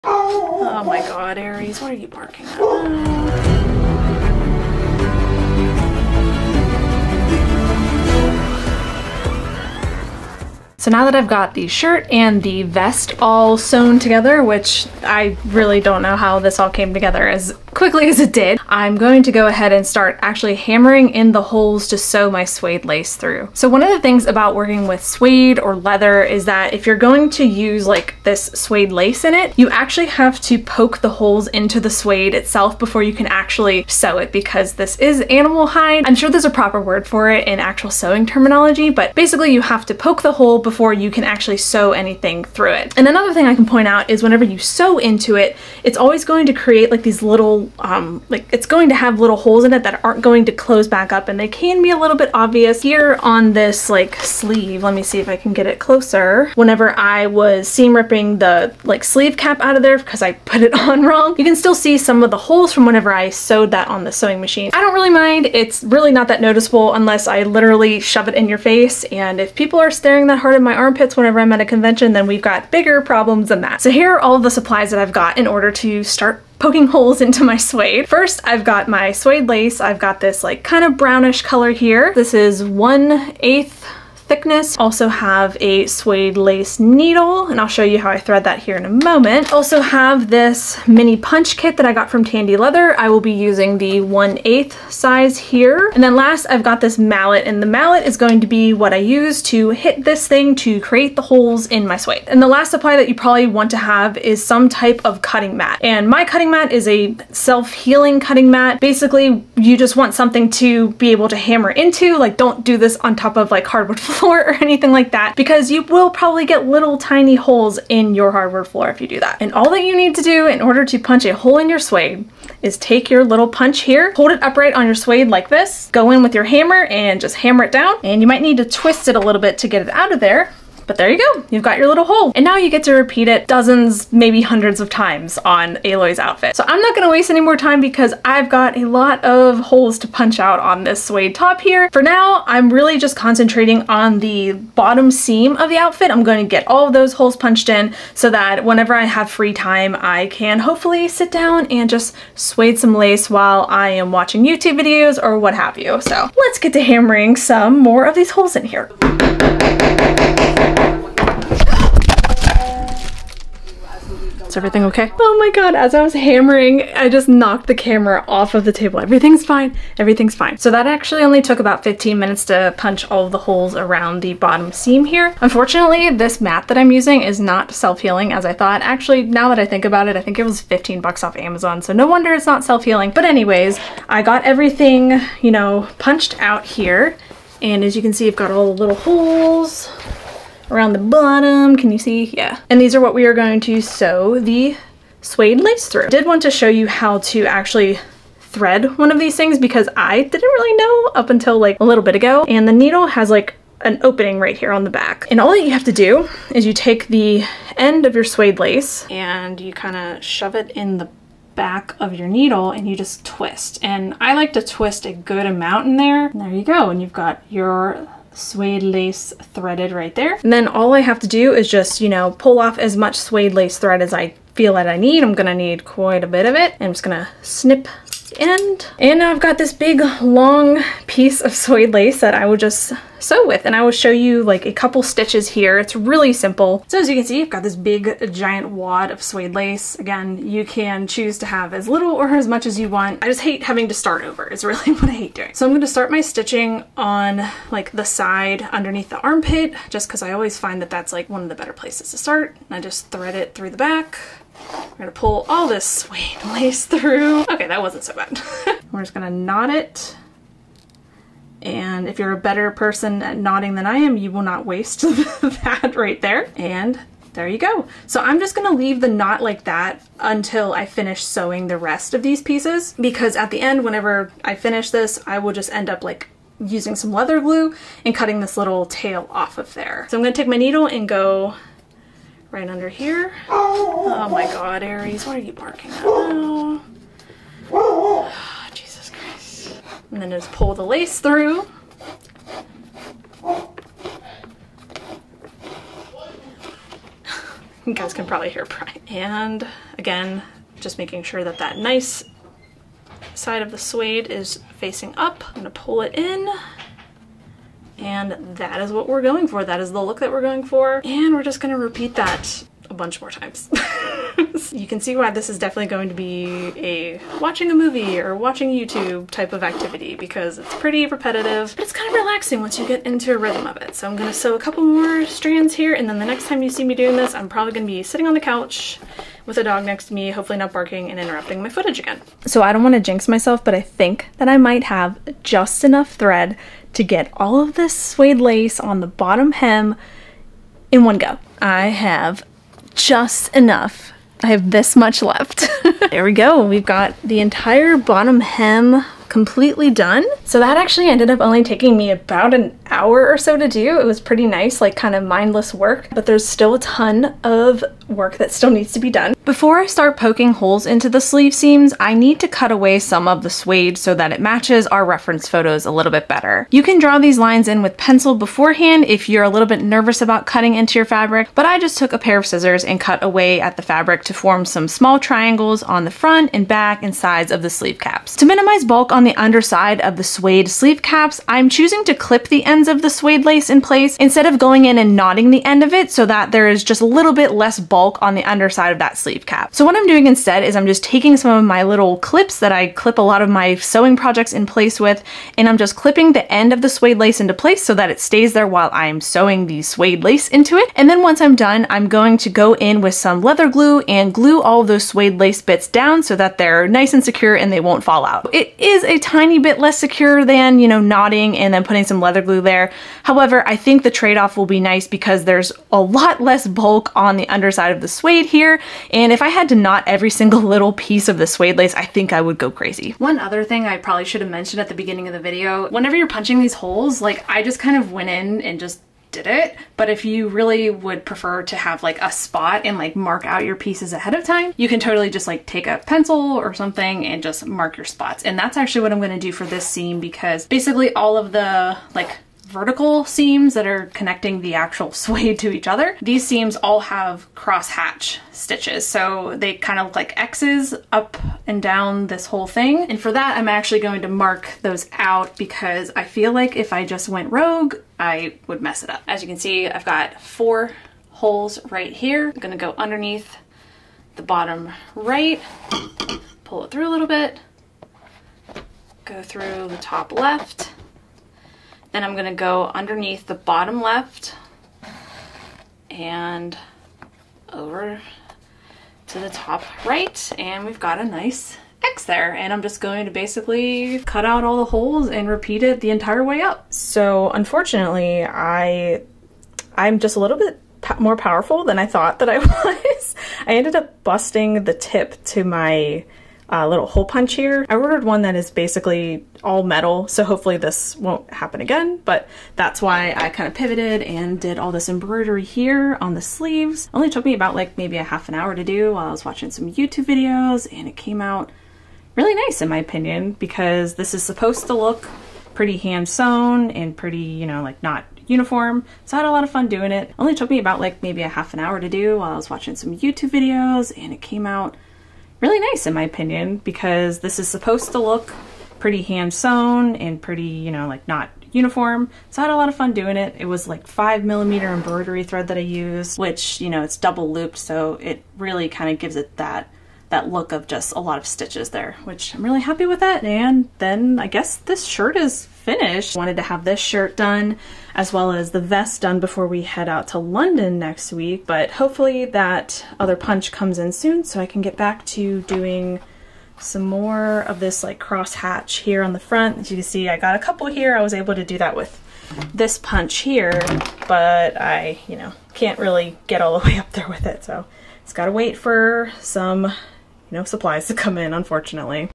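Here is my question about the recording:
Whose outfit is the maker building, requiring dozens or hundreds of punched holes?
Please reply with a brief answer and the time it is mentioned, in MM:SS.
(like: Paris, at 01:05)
Aloy, at 02:15.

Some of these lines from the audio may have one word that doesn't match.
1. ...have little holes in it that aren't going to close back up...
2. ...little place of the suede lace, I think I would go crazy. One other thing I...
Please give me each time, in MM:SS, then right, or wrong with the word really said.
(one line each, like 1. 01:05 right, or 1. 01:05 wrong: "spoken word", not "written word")
1. 00:48 right
2. 07:00 wrong: "piece", not "place".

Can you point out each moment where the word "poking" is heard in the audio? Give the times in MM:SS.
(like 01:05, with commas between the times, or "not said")
01:16, 06:00.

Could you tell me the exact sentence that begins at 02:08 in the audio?
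And you might need to twist it a little bit to get it out of there.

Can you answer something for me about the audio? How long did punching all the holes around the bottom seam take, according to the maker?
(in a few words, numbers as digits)
15 minutes.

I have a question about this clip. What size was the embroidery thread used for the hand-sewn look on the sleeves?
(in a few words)
5 millimeter.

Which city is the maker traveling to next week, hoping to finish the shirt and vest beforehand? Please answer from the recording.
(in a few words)
London.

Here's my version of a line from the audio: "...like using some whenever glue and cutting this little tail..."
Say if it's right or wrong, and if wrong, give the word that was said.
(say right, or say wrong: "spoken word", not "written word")
wrong: "leather", not "whenever".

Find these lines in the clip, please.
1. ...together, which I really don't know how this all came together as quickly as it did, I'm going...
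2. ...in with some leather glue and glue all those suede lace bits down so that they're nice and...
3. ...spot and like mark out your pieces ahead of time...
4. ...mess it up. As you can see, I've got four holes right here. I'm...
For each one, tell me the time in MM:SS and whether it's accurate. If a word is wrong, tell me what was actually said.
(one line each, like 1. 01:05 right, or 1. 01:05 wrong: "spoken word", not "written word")
1. 00:13 right
2. 06:42 right
3. 07:12 right
4. 07:38 right.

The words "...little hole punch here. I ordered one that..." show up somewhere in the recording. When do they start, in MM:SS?
08:16.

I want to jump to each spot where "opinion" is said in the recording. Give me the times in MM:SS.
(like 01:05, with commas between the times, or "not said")
08:32, 08:46.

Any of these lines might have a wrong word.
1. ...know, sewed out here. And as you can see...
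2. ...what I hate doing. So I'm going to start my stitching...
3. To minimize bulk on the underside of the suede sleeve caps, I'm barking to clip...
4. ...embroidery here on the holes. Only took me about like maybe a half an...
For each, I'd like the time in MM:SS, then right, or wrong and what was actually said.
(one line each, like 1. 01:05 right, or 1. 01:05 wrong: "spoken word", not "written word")
1. 03:05 wrong: "punched", not "sewed"
2. 04:04 right
3. 06:18 wrong: "choosing", not "barking"
4. 08:25 wrong: "sleeves", not "holes".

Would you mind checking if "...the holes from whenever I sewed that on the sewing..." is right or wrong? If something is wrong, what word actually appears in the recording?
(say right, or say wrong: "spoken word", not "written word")
right.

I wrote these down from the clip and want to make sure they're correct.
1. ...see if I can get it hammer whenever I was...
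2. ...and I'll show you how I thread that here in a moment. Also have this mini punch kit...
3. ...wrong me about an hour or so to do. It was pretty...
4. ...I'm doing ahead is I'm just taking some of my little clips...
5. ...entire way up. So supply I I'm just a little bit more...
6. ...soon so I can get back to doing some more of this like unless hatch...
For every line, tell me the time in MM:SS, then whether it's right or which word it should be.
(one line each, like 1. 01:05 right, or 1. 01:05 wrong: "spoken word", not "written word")
1. 00:55 wrong: "closer", not "hammer"
2. 01:27 right
3. 05:51 wrong: "taking", not "wrong"
4. 06:29 wrong: "instead", not "ahead"
5. 08:06 wrong: "unfortunately", not "supply"
6. 09:14 wrong: "cross", not "unless".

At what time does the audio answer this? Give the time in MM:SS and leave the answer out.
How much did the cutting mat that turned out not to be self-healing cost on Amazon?
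03:00.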